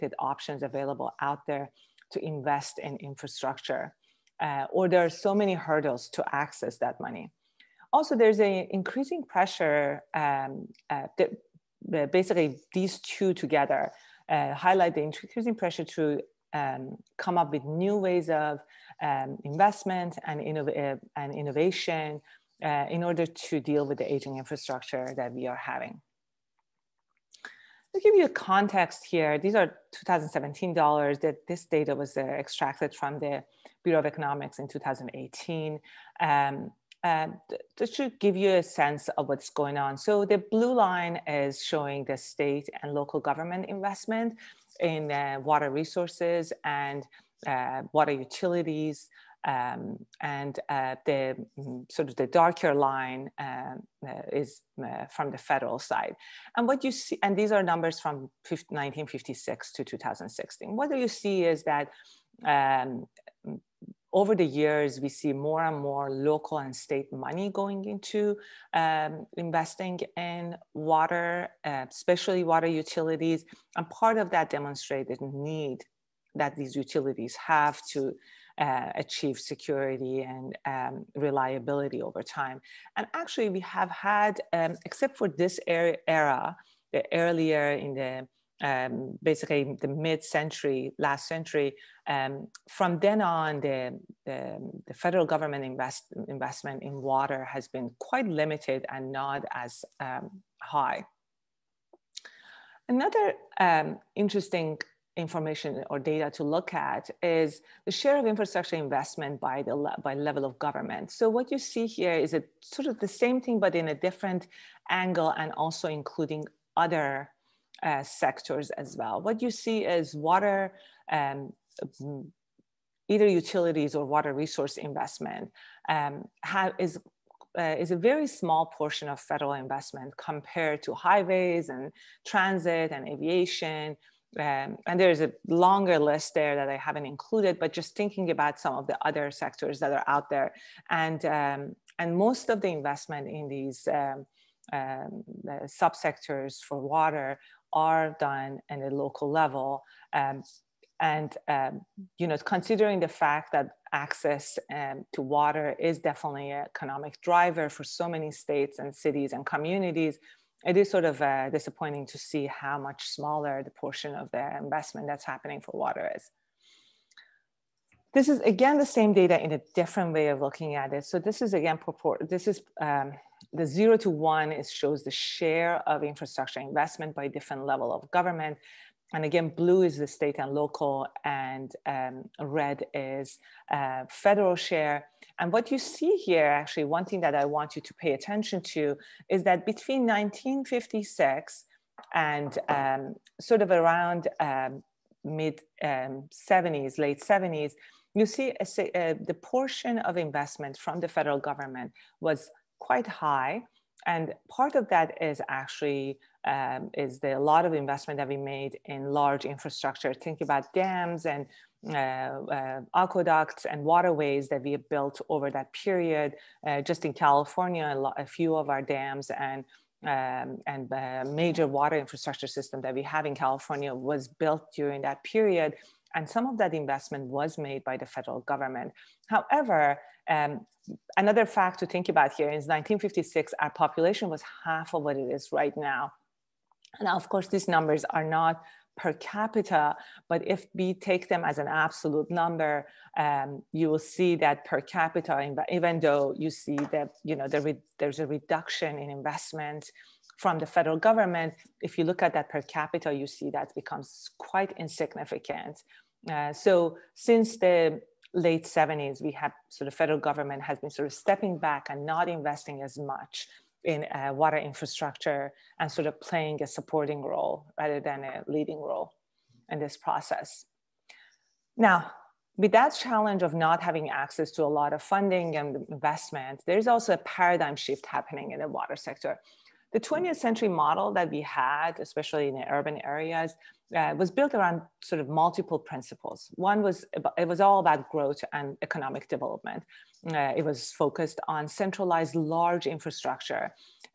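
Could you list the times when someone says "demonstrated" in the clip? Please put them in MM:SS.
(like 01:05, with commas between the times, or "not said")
01:14.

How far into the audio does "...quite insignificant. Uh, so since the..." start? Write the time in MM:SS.
04:14.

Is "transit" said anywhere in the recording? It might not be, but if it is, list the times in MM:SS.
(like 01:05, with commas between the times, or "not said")
02:12.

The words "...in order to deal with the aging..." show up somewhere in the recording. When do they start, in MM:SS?
00:22.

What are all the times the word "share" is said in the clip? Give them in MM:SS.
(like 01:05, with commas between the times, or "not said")
01:47, 02:55, 03:04.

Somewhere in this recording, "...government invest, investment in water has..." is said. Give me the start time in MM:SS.
01:35.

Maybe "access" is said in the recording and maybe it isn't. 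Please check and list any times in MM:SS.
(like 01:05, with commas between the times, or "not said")
00:06, 02:33, 04:34.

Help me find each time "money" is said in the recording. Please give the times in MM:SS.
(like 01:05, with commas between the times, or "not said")
00:07, 01:07.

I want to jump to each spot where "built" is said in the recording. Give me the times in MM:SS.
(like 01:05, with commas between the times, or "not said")
03:34, 03:44, 04:44.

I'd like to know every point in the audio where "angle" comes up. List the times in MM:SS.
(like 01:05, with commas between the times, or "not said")
01:54.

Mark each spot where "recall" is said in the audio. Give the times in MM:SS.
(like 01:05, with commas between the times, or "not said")
not said.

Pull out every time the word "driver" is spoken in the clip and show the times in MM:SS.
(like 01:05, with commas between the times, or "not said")
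02:37.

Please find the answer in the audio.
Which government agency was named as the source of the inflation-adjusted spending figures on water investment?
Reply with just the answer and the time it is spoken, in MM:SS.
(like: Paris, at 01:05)
Bureau of Economics, at 00:33.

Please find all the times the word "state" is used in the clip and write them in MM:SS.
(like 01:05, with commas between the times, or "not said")
00:42, 01:06, 02:38, 03:00.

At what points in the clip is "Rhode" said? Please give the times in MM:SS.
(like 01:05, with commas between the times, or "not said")
not said.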